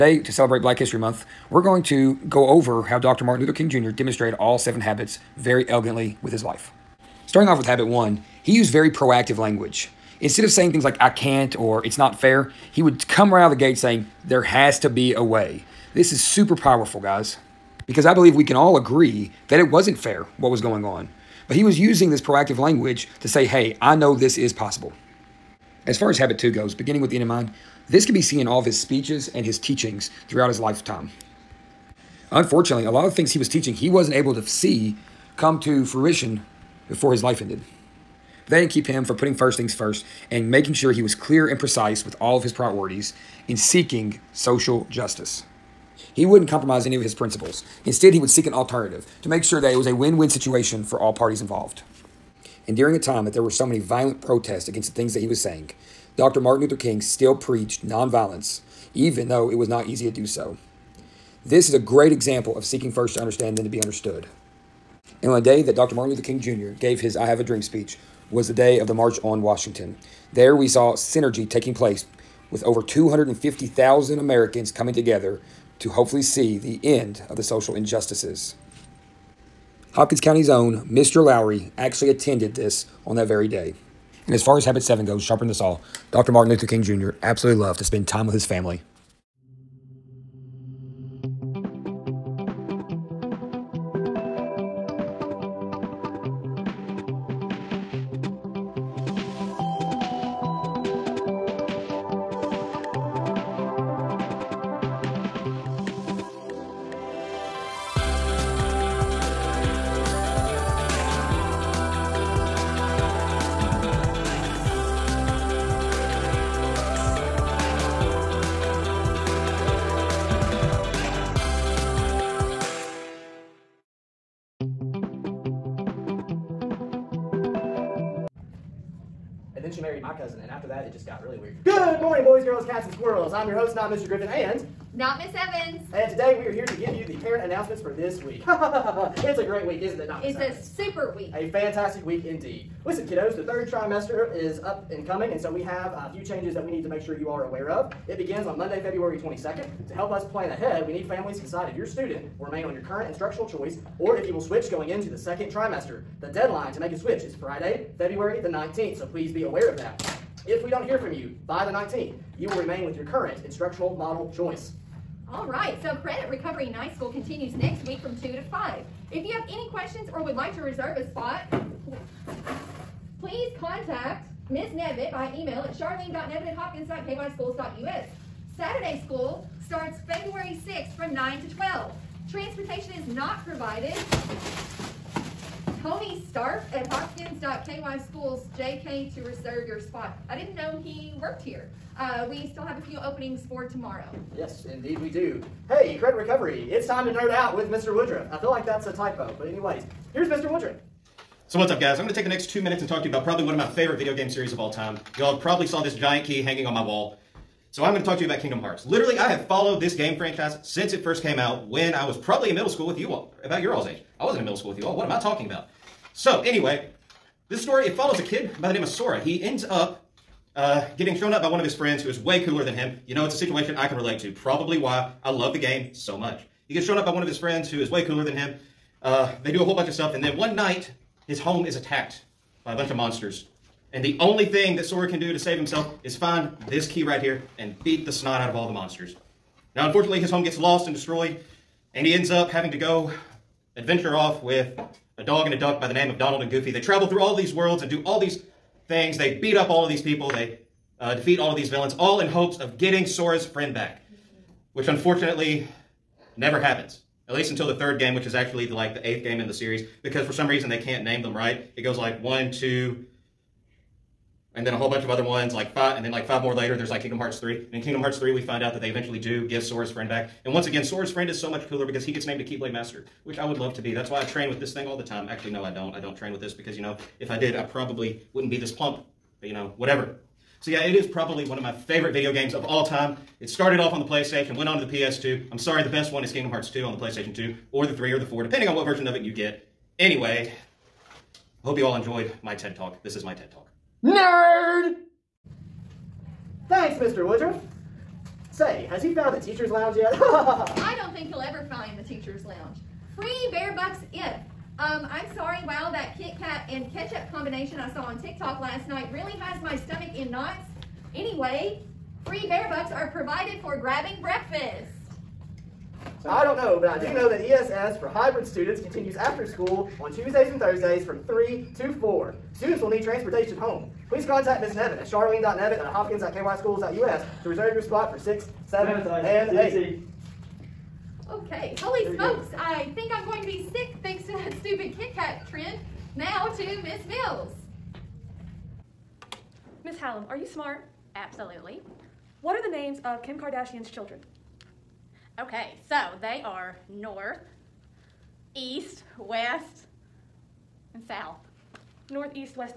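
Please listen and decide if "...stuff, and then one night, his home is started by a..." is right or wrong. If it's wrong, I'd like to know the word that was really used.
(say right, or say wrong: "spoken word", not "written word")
wrong: "attacked", not "started".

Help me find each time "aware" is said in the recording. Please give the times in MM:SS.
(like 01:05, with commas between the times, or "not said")
02:27, 02:39.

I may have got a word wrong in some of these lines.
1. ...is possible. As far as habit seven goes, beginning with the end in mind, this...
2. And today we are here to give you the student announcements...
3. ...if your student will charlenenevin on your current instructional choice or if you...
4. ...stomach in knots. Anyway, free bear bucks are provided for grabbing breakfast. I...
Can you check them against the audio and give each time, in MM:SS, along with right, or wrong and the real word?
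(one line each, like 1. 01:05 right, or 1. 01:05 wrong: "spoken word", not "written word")
1. 00:24 wrong: "two", not "seven"
2. 02:15 wrong: "parent", not "student"
3. 02:31 wrong: "remain", not "charlenenevin"
4. 05:09 right.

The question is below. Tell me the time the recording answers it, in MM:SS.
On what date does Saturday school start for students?
03:00.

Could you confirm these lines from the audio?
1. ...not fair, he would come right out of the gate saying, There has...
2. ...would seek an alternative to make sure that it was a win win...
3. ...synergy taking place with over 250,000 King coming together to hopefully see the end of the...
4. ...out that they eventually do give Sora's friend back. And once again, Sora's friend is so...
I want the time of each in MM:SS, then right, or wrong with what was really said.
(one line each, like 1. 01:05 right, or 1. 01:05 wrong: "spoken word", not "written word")
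1. 00:11 right
2. 00:48 right
3. 01:10 wrong: "Americans", not "King"
4. 04:28 right.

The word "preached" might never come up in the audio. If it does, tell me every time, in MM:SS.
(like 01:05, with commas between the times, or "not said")
00:57.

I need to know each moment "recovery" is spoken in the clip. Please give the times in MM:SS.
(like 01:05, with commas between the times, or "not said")
02:46, 03:16.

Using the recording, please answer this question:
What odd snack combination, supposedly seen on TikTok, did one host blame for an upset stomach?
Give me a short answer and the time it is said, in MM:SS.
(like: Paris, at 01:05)
Kit Kat and ketchup, at 05:06.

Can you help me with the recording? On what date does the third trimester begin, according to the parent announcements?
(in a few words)
February 22nd.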